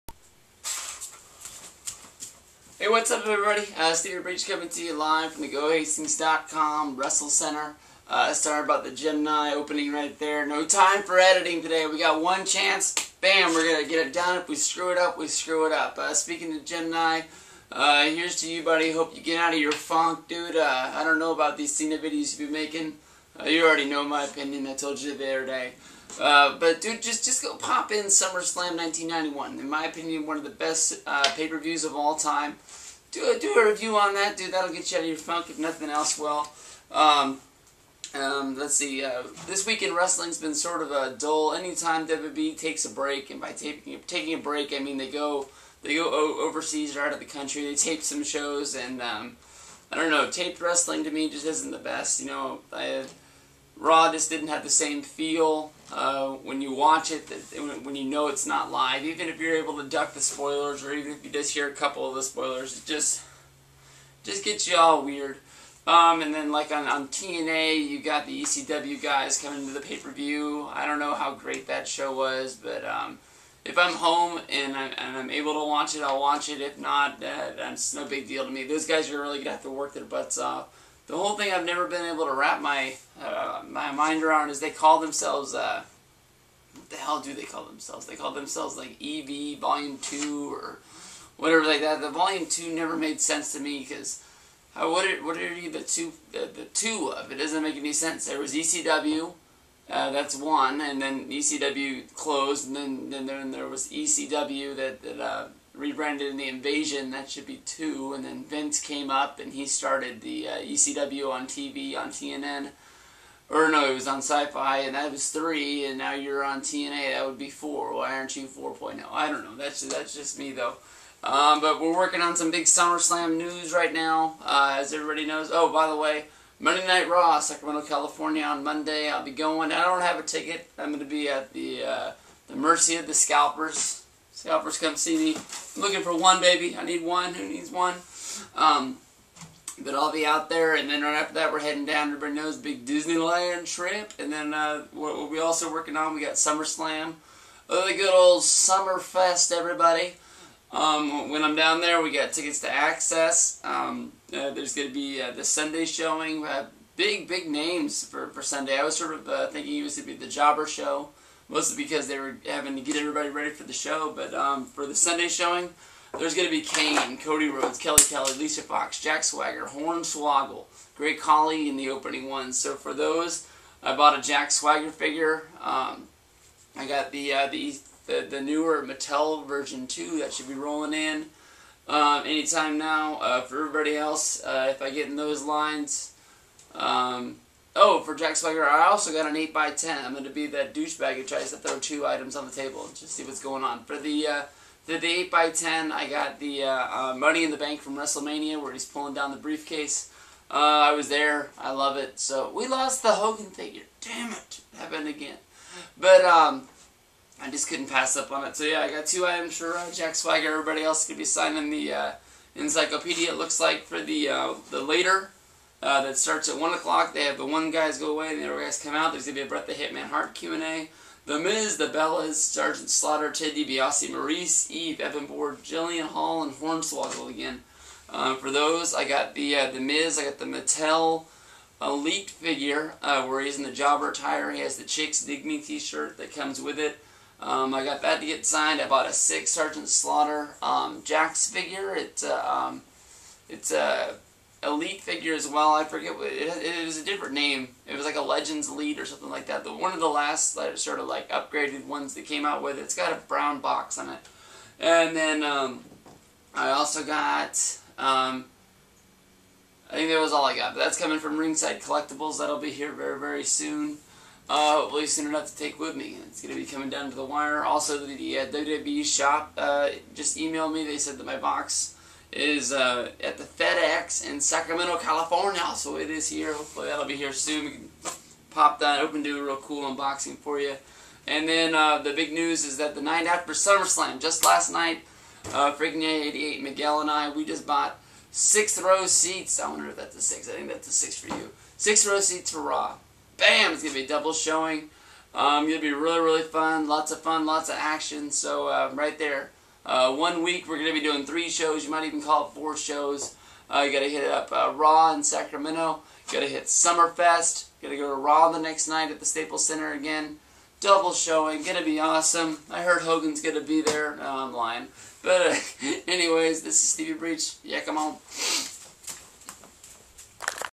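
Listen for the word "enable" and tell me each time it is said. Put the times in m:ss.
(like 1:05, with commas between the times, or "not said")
not said.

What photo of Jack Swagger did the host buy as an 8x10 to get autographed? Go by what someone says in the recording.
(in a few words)
Money in the Bank.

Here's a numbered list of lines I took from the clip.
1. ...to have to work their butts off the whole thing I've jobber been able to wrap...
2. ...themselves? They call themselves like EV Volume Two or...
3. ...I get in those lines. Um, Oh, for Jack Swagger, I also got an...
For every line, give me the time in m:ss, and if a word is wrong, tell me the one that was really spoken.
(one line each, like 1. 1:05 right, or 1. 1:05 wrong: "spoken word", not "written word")
1. 1:19 wrong: "never", not "jobber"
2. 1:27 right
3. 3:04 right.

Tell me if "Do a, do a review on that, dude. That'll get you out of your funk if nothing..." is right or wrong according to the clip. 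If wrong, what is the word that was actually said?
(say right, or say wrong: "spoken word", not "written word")
right.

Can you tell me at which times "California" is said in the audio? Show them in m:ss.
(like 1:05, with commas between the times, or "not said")
2:07, 4:34.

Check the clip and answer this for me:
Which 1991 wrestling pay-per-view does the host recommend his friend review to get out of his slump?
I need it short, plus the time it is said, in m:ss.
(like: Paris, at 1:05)
SummerSlam 1991, at 0:28.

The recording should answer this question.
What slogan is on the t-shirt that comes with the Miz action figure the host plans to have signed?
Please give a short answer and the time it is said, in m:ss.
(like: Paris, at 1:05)
Chicks Dig Me, at 3:54.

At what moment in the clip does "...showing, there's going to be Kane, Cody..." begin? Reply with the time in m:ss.
2:45.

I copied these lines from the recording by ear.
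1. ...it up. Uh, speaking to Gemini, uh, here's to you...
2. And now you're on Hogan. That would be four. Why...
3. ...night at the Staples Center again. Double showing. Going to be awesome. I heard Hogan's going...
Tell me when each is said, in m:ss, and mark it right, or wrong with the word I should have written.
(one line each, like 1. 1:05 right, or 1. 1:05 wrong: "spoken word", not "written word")
1. 0:15 right
2. 1:55 wrong: "TNA", not "Hogan"
3. 5:08 right.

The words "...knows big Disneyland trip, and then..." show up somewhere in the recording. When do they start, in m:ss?
2:22.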